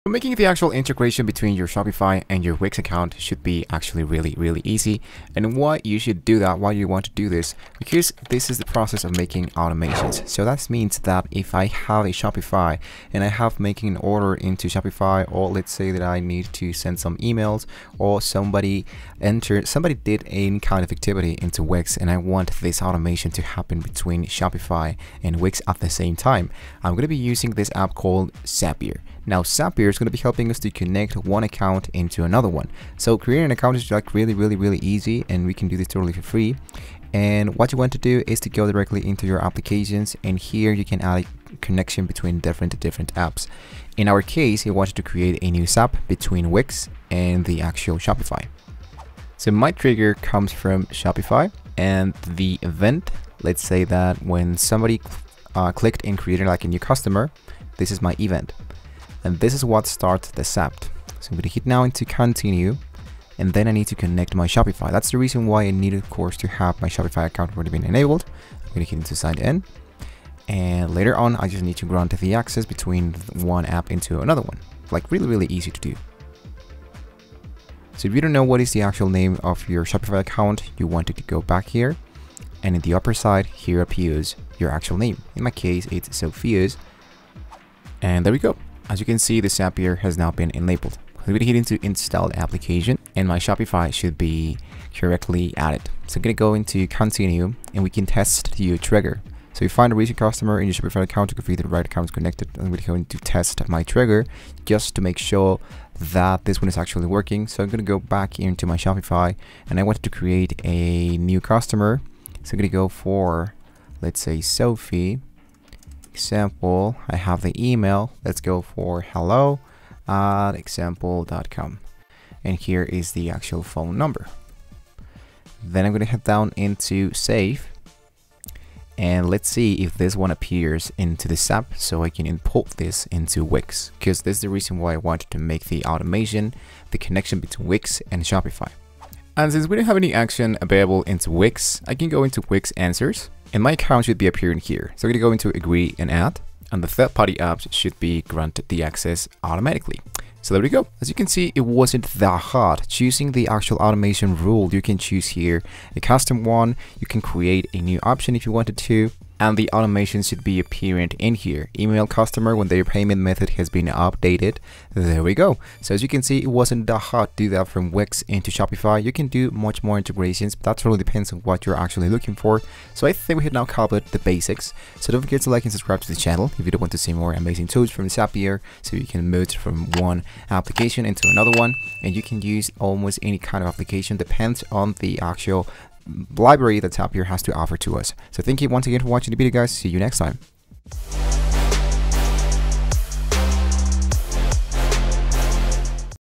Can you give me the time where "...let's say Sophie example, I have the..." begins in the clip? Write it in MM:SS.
01:54.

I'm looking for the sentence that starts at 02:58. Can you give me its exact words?
So you can move from one application into another one.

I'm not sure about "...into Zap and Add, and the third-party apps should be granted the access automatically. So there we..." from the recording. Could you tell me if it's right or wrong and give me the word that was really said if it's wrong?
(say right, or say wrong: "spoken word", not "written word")
wrong: "Agree", not "Zap".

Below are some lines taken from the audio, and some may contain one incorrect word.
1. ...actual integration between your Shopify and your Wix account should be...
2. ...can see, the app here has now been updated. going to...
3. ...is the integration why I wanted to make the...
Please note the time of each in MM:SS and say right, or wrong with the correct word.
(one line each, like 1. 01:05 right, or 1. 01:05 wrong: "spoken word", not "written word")
1. 00:00 right
2. 01:29 wrong: "enabled", not "updated"
3. 02:14 wrong: "reason", not "integration".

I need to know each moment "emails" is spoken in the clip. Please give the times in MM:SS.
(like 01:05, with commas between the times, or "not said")
00:17, 01:57, 02:41.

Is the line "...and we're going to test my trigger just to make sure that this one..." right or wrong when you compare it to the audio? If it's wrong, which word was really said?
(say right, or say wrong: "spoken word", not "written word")
right.